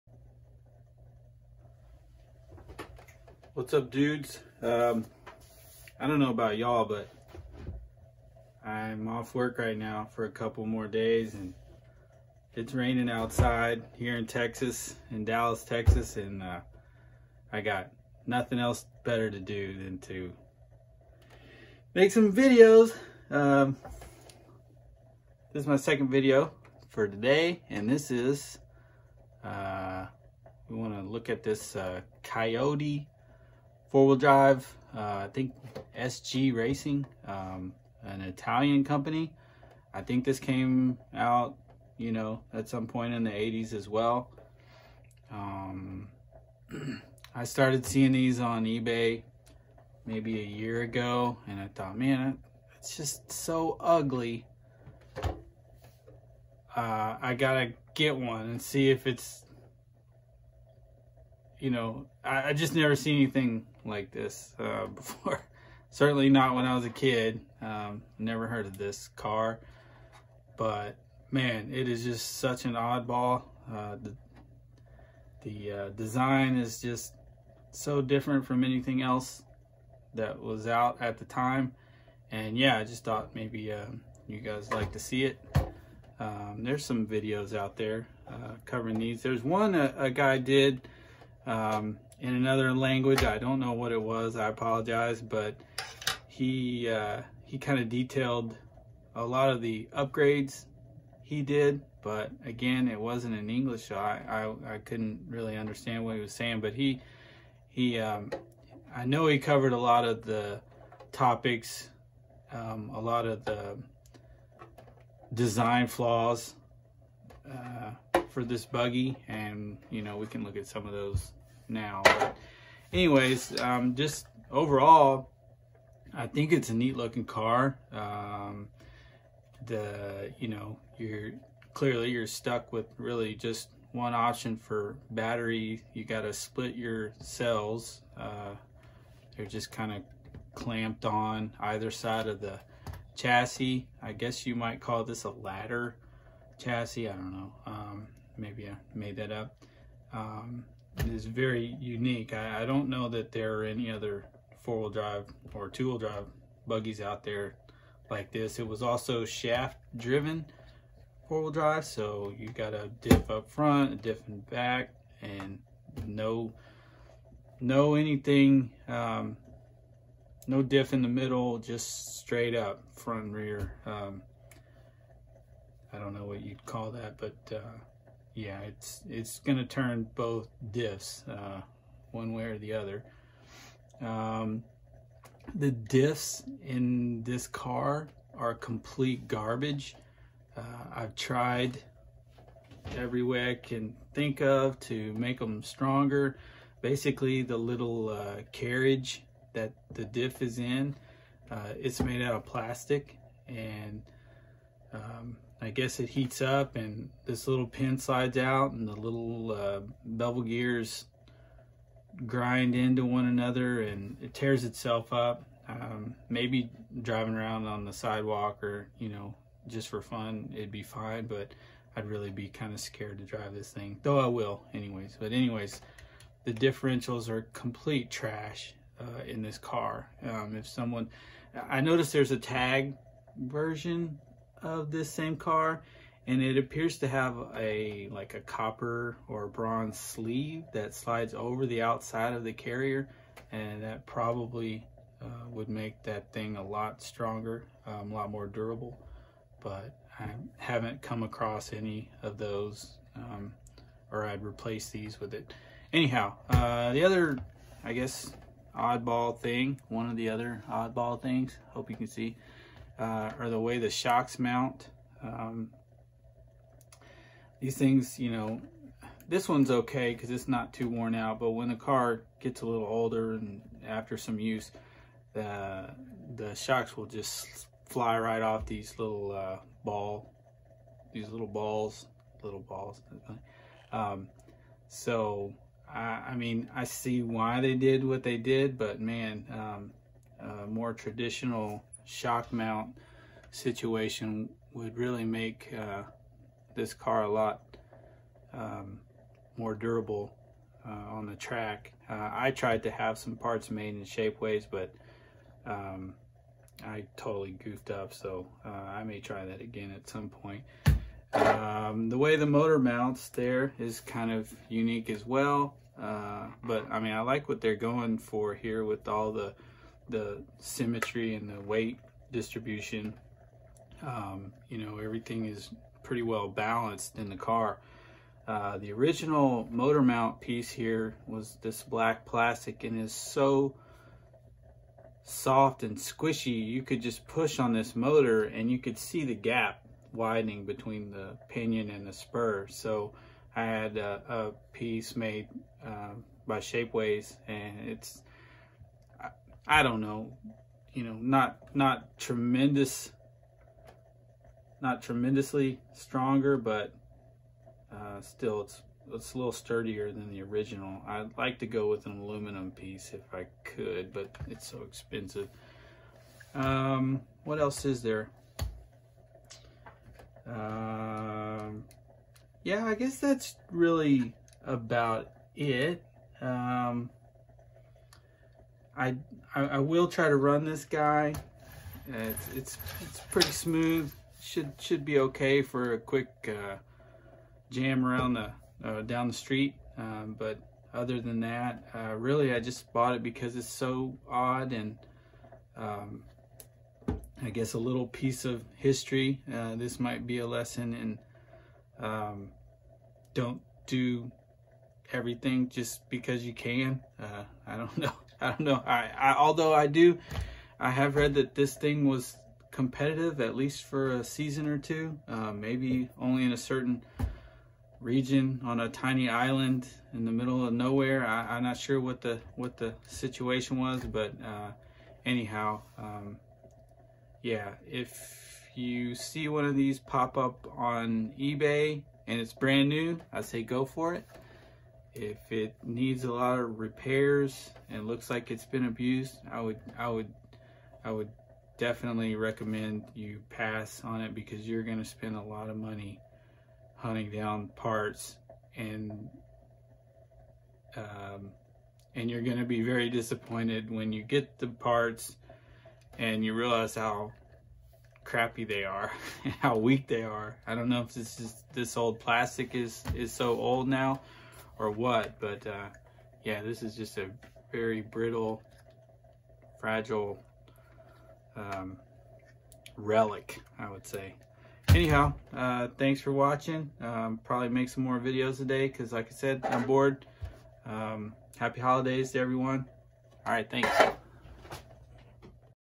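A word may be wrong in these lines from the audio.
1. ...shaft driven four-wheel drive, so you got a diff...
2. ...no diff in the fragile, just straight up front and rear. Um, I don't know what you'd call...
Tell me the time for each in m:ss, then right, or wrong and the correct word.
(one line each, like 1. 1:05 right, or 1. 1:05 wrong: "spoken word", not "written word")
1. 2:39 right
2. 2:50 wrong: "middle", not "fragile".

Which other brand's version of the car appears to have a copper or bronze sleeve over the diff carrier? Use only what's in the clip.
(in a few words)
Tag.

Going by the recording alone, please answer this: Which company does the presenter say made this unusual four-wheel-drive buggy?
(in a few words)
SG Racing.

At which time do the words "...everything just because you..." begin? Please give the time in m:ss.
6:45.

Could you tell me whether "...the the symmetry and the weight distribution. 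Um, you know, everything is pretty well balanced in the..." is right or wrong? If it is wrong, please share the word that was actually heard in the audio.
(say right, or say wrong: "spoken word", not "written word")
right.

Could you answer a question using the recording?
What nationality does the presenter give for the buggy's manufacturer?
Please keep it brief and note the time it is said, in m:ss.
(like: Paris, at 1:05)
Italian, at 0:38.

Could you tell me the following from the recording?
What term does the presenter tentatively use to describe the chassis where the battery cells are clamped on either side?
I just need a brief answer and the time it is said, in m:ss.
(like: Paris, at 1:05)
ladder chassis, at 2:25.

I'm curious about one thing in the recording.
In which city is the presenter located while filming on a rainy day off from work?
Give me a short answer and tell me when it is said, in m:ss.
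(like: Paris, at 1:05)
Dallas, at 0:15.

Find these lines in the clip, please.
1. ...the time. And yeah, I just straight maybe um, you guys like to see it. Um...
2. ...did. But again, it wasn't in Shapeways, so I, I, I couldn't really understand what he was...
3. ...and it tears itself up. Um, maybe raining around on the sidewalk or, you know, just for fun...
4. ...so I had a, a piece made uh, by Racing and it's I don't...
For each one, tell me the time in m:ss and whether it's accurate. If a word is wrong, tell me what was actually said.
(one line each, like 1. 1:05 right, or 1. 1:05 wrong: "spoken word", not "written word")
1. 1:21 wrong: "thought", not "straight"
2. 1:41 wrong: "English", not "Shapeways"
3. 3:33 wrong: "driving", not "raining"
4. 5:42 wrong: "Shapeways", not "Racing".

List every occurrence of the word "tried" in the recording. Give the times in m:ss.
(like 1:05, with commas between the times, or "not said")
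3:11, 5:02.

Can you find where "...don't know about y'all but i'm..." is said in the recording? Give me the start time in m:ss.
0:06.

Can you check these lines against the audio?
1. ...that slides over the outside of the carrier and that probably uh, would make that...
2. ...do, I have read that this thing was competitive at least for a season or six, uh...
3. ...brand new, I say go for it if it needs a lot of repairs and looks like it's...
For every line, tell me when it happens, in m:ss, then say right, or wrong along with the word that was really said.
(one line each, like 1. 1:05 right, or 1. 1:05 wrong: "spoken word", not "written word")
1. 4:00 right
2. 6:49 wrong: "two", not "six"
3. 7:12 right.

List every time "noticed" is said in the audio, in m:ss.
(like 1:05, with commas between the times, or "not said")
3:51.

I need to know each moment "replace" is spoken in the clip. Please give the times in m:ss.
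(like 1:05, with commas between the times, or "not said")
4:14.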